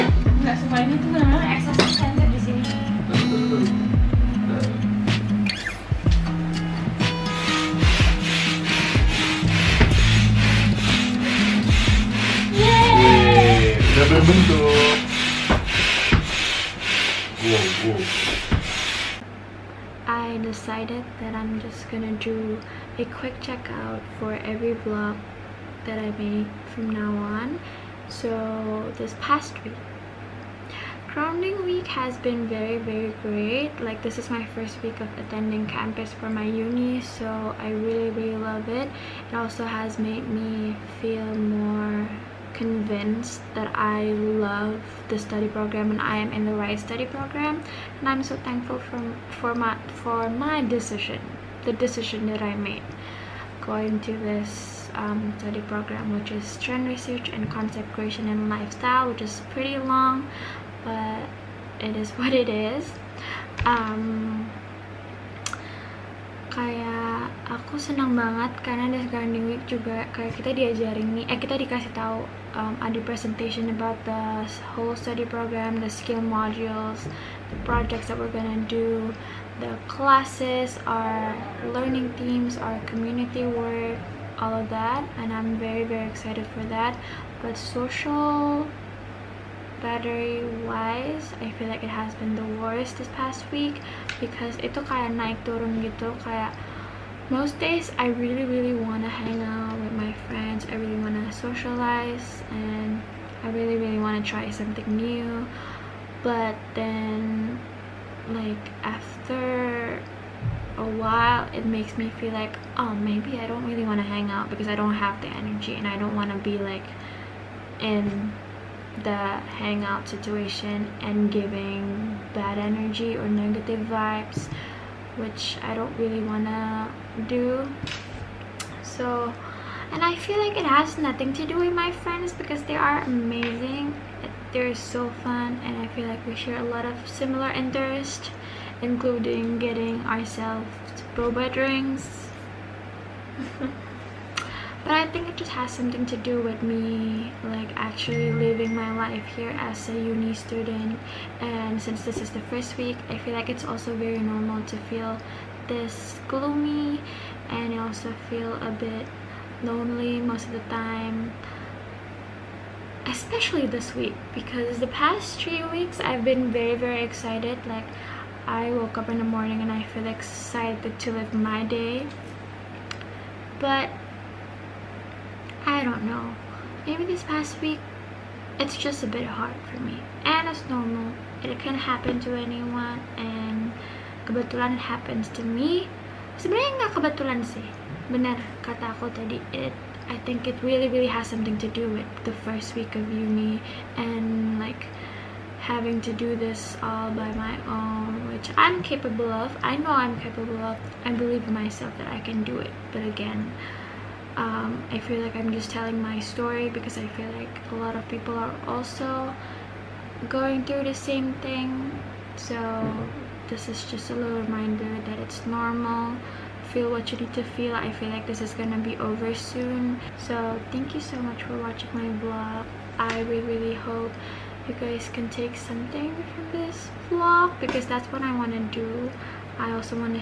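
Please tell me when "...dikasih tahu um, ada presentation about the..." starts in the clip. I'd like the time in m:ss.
1:11.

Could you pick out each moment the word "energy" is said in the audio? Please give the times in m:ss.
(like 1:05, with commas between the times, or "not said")
1:55, 2:02.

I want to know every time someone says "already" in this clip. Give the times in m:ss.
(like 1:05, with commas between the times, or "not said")
not said.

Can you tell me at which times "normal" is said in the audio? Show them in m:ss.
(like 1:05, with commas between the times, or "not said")
2:34, 3:00, 3:35.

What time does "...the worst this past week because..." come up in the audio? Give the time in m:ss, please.
1:32.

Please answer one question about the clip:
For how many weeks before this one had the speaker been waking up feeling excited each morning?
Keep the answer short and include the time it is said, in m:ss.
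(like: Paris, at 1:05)
3, at 2:45.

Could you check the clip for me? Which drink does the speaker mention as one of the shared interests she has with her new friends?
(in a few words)
Boba drinks.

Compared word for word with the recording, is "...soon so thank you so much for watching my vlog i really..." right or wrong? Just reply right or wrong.
right.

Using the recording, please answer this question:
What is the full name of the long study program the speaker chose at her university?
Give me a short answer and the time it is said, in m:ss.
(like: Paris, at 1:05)
Trend Research and Concept Creation and Lifestyle, at 0:56.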